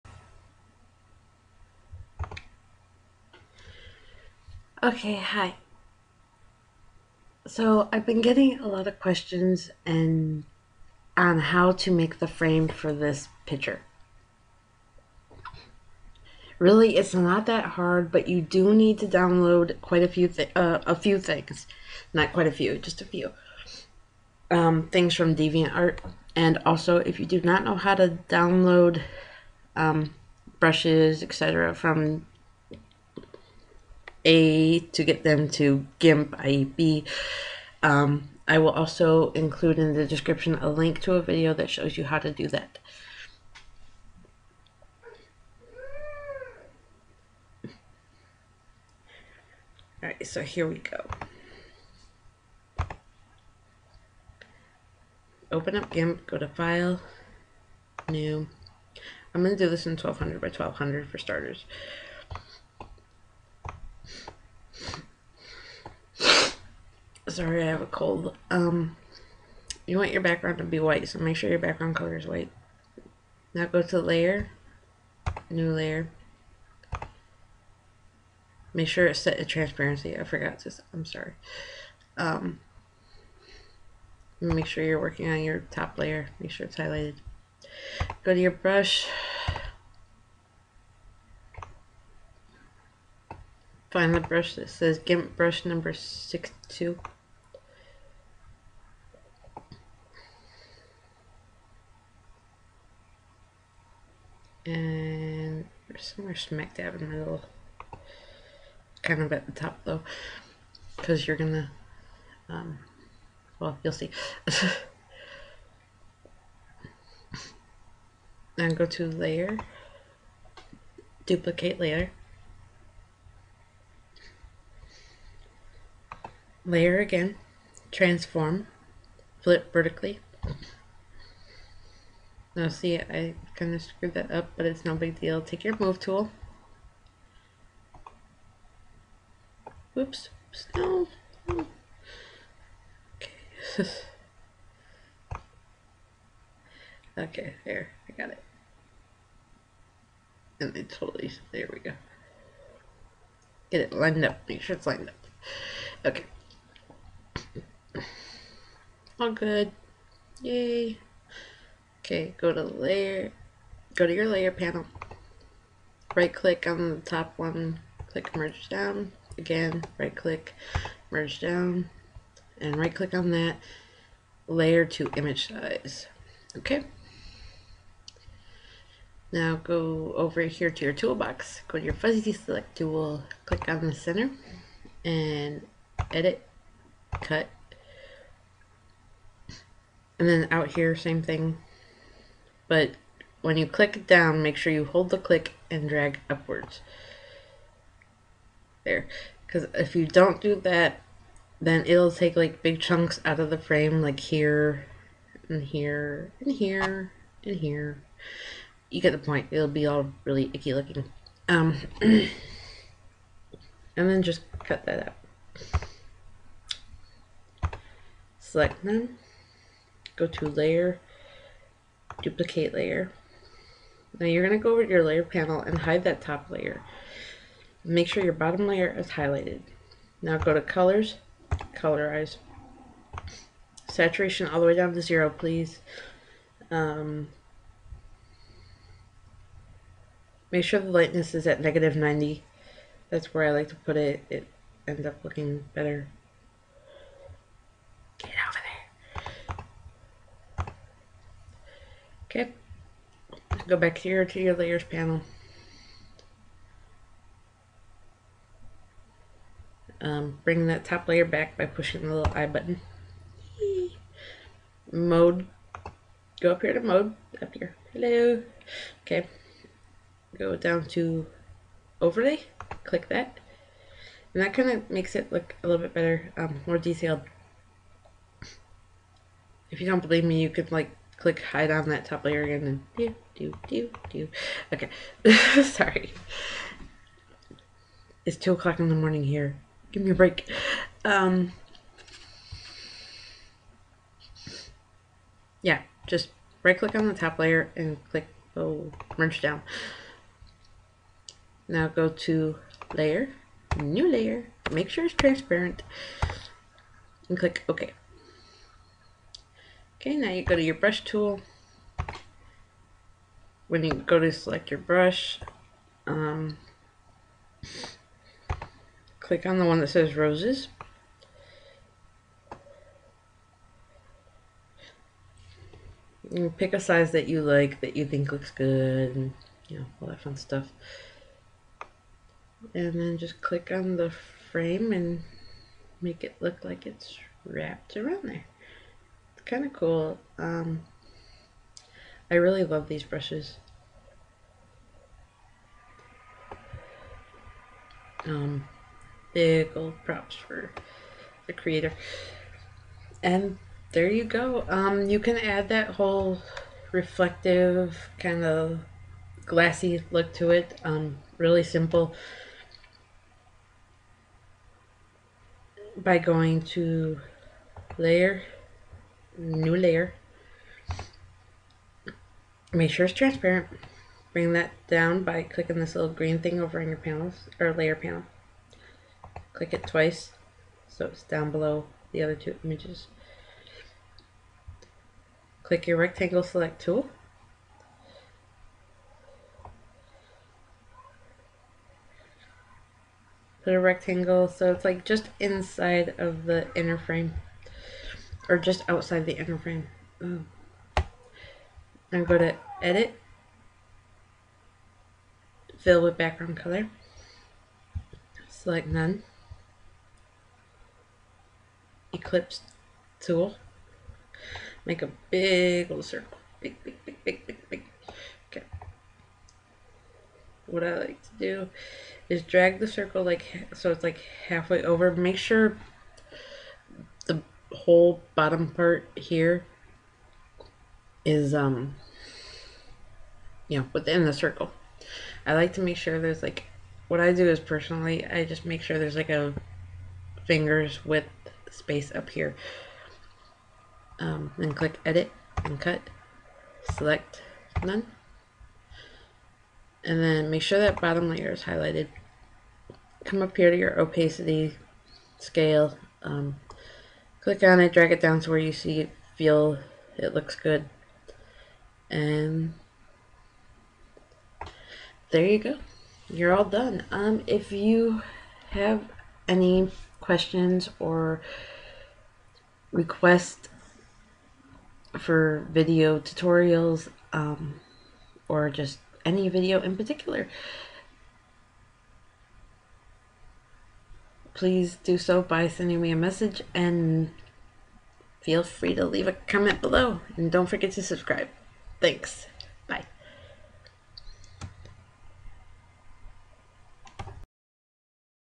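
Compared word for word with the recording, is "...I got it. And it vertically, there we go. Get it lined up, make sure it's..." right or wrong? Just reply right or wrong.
wrong.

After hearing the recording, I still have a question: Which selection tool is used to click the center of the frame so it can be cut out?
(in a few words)
Fuzzy select tool.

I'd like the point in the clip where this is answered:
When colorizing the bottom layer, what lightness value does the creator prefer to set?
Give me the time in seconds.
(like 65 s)
241 s.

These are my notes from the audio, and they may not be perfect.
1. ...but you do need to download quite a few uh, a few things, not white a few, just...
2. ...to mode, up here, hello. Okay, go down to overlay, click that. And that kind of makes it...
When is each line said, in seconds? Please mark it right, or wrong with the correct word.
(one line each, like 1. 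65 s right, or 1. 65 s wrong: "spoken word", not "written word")
1. 18 s wrong: "quite", not "white"
2. 266 s right.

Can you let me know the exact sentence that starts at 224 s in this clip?
Now you're going to go over to your layer panel and hide that top layer.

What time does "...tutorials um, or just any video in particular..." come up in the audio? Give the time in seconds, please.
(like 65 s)
476 s.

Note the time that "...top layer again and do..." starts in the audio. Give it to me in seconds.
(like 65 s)
282 s.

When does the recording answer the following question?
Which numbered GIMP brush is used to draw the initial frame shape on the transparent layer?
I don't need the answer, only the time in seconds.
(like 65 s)
95 s.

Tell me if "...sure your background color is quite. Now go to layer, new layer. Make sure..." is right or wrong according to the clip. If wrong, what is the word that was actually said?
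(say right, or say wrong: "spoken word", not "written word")
wrong: "white", not "quite".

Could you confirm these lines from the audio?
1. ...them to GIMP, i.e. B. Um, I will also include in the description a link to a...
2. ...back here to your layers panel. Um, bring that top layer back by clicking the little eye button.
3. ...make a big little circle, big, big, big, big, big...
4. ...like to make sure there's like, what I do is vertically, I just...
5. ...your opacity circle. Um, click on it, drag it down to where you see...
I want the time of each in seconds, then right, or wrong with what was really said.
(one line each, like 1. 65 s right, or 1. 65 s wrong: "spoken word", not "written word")
1. 35 s right
2. 253 s wrong: "pushing", not "clicking"
3. 414 s right
4. 435 s wrong: "personally", not "vertically"
5. 453 s wrong: "scale", not "circle".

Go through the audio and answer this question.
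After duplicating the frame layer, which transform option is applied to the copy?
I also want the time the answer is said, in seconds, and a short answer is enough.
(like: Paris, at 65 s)
Flip vertically, at 129 s.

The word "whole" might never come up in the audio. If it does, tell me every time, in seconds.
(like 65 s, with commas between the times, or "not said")
355 s, 427 s.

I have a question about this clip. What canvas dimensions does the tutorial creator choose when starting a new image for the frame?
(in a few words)
1200 by 1200.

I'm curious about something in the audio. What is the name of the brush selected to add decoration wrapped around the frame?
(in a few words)
Roses.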